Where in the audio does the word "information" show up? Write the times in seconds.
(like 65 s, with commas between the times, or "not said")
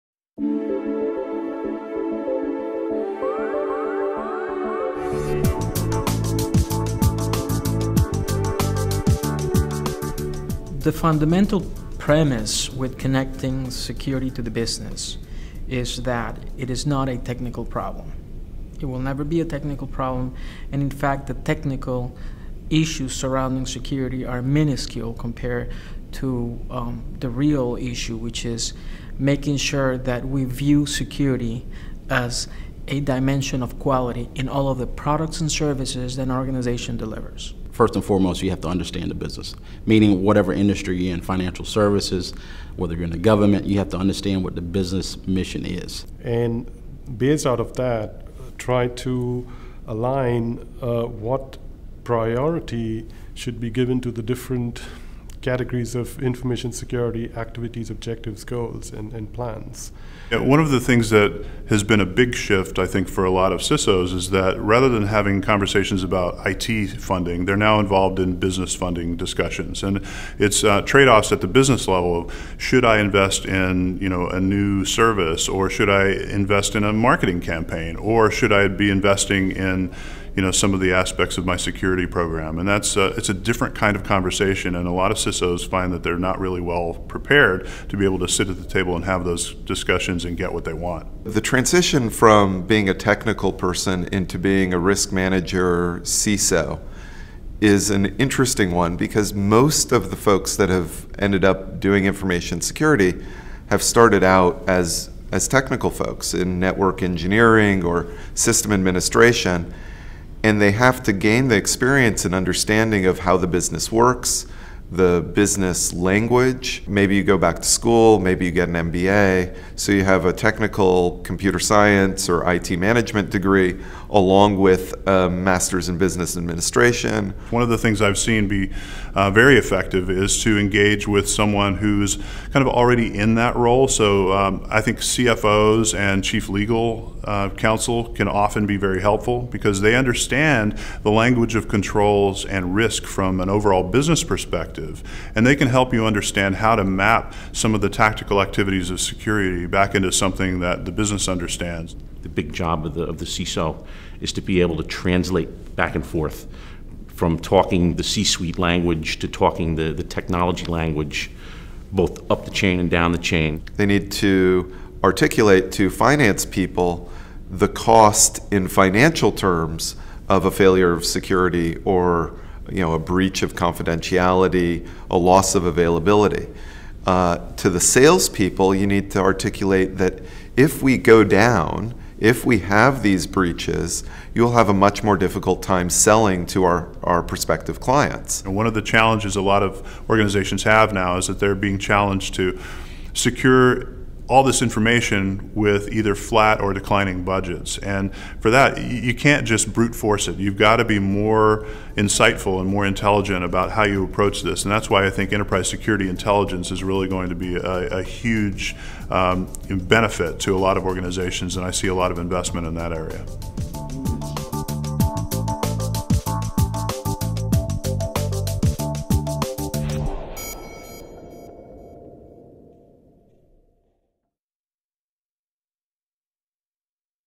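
56 s, 102 s, 194 s.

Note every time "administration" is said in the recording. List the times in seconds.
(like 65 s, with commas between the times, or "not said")
108 s, 126 s.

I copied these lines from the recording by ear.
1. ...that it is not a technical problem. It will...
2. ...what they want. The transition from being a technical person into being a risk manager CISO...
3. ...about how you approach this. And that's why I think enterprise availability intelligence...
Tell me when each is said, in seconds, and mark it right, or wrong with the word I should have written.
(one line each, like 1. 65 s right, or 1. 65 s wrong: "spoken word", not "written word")
1. 16 s right
2. 90 s right
3. 203 s wrong: "security", not "availability".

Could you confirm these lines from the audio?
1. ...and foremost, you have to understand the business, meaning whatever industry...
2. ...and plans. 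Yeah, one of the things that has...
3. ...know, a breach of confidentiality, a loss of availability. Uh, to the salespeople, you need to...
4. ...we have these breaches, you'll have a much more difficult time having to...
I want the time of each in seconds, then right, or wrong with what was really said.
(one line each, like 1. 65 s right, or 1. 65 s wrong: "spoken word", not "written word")
1. 37 s right
2. 59 s right
3. 172 s right
4. 182 s wrong: "selling", not "having".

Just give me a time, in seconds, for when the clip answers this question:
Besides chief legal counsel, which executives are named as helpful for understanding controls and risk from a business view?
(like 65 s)
134 s.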